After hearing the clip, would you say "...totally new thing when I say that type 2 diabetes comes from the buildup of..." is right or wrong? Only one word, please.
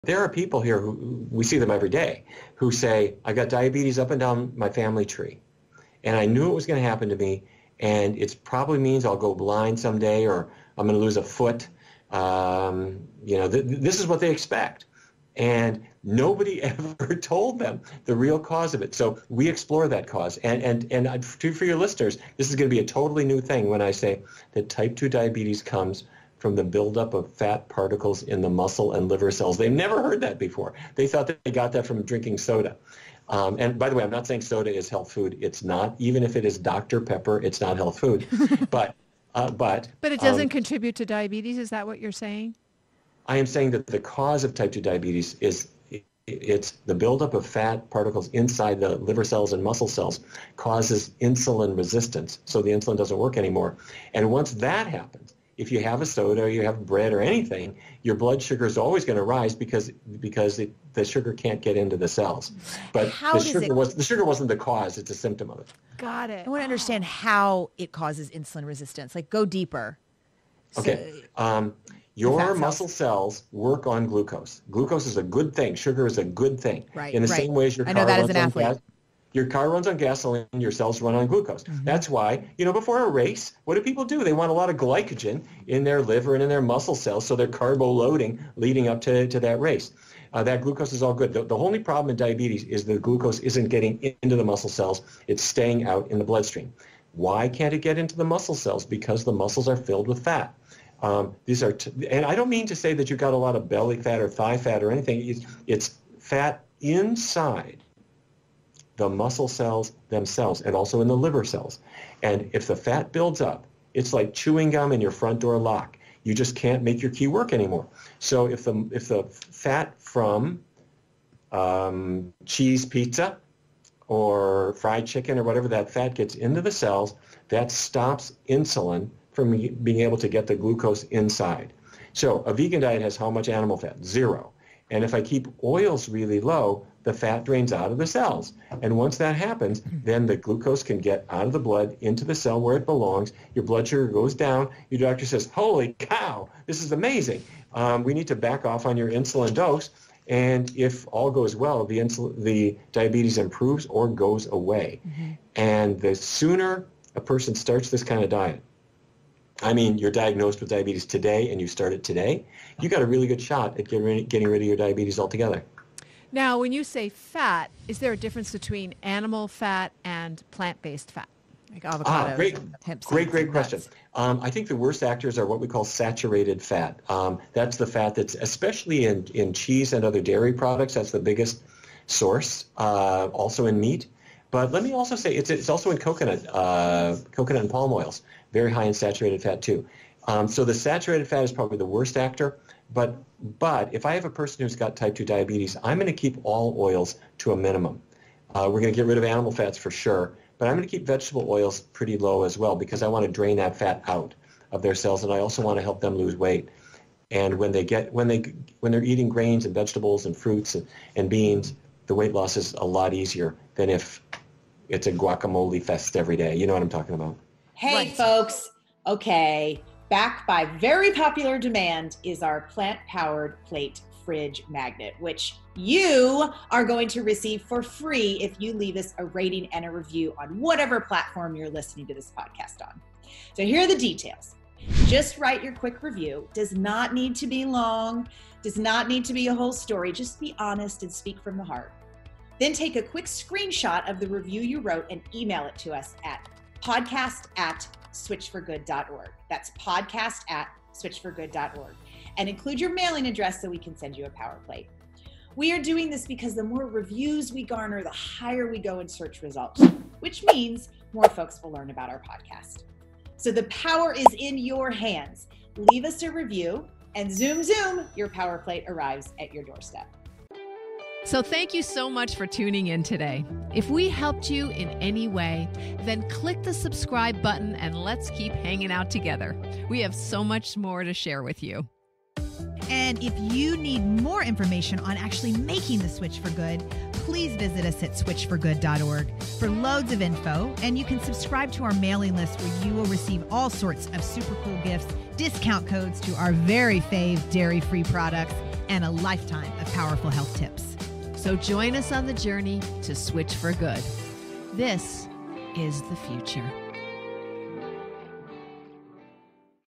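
right.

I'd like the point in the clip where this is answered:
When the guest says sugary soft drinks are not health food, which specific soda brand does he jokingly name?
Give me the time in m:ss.
0:36.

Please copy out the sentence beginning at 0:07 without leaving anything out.
And it probably means I'll go blind someday or I'm going to lose a foot.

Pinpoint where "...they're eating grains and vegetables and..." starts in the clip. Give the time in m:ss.
3:28.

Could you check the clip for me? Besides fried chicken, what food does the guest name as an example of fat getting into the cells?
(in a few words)
Cheese pizza.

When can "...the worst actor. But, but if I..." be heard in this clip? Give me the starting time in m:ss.
3:11.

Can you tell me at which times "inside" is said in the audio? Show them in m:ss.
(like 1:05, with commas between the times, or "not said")
0:48, 1:46, 2:11.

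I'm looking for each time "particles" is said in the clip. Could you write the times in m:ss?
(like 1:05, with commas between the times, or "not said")
0:27, 0:47.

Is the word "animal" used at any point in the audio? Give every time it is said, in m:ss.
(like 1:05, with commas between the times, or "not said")
2:13, 2:49, 3:19.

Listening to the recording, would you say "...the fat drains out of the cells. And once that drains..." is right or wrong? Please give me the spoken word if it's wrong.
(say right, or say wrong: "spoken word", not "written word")
wrong: "happens", not "drains".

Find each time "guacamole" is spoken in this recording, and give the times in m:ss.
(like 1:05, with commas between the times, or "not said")
3:35.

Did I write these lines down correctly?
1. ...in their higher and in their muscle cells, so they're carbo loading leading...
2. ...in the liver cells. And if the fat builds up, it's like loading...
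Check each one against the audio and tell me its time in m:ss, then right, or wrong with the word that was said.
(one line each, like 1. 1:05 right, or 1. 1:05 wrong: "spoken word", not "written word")
1. 1:25 wrong: "liver", not "higher"
2. 1:51 wrong: "chewing", not "loading".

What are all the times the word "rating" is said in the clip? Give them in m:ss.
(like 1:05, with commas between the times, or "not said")
3:49.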